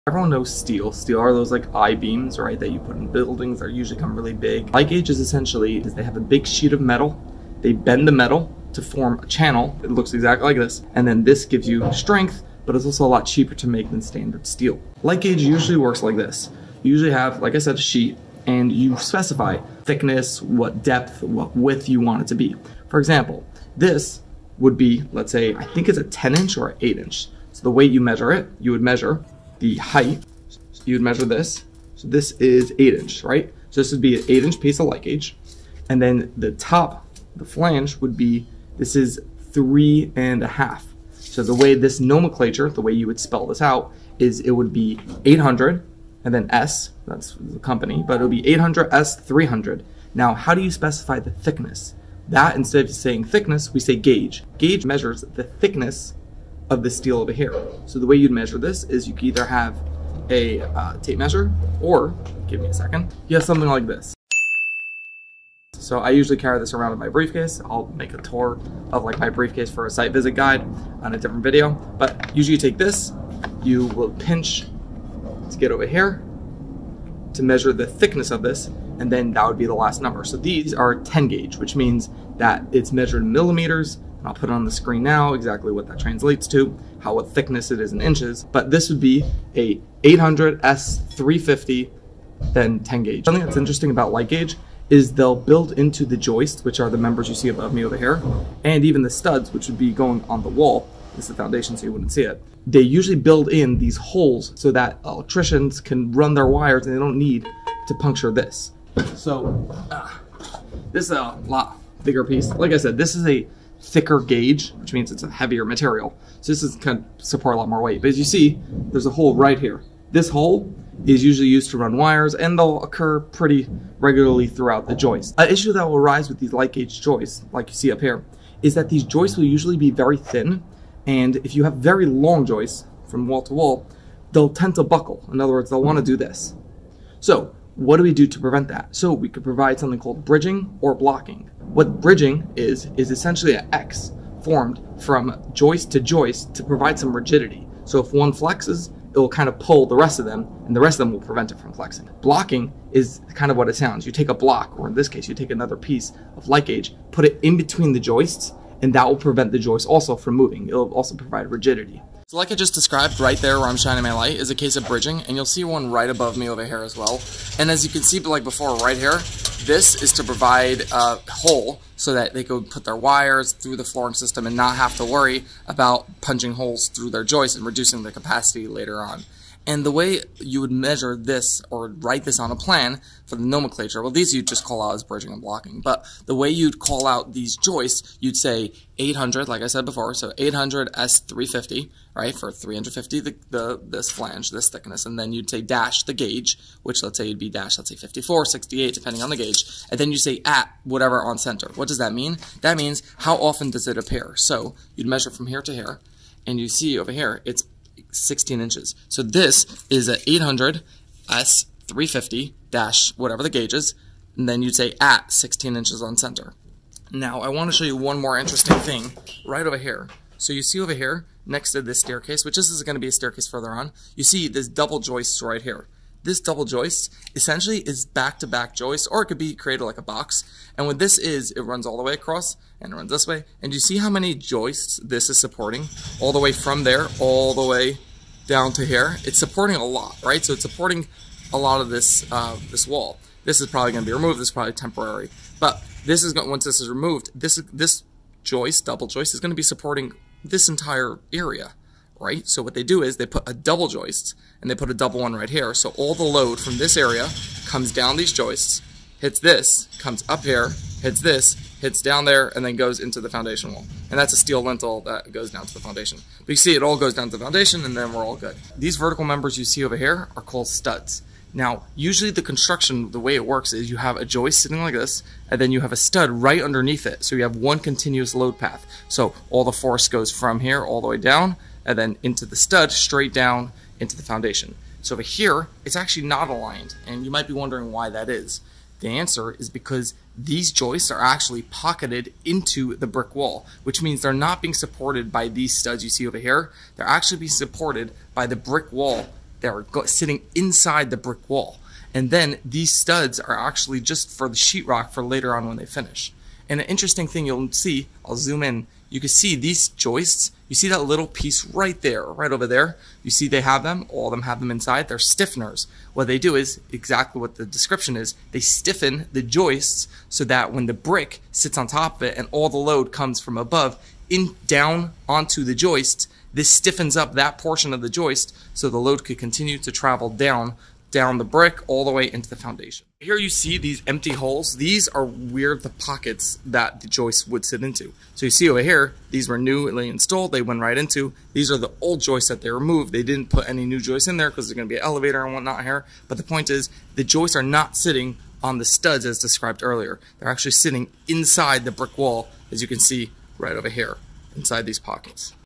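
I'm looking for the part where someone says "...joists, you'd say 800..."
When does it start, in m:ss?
3:07.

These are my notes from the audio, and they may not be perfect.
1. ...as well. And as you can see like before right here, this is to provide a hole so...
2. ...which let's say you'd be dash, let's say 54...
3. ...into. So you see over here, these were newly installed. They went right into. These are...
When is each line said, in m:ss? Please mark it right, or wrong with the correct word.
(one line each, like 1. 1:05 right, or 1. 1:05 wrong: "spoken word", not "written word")
1. 2:46 right
2. 3:16 right
3. 5:37 right.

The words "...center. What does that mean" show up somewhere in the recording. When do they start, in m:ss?
3:21.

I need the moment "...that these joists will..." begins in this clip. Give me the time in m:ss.
2:08.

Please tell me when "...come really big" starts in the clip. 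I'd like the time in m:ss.
0:03.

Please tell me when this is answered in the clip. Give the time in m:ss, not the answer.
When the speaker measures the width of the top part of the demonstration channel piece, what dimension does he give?
0:39.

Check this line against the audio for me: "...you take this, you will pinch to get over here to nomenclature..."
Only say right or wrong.
wrong.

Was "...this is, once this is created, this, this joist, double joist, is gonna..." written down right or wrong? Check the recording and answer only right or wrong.
wrong.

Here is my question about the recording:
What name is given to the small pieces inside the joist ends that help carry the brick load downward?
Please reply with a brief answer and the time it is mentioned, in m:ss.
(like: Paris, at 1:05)
stiffeners, at 5:15.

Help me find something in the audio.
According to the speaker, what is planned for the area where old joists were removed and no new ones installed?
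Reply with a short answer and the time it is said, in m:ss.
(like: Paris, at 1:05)
an elevator, at 5:44.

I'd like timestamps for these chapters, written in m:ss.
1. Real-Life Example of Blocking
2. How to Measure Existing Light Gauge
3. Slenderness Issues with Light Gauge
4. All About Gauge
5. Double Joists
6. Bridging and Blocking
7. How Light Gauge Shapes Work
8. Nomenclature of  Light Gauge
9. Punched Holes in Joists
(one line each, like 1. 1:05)
1. 2:42
2. 0:27
3. 2:05
4. 0:53
5. 3:39
6. 2:19
7. 0:15
8. 3:03
9. 1:33.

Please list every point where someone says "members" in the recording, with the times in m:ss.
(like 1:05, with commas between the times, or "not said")
1:36, 4:29.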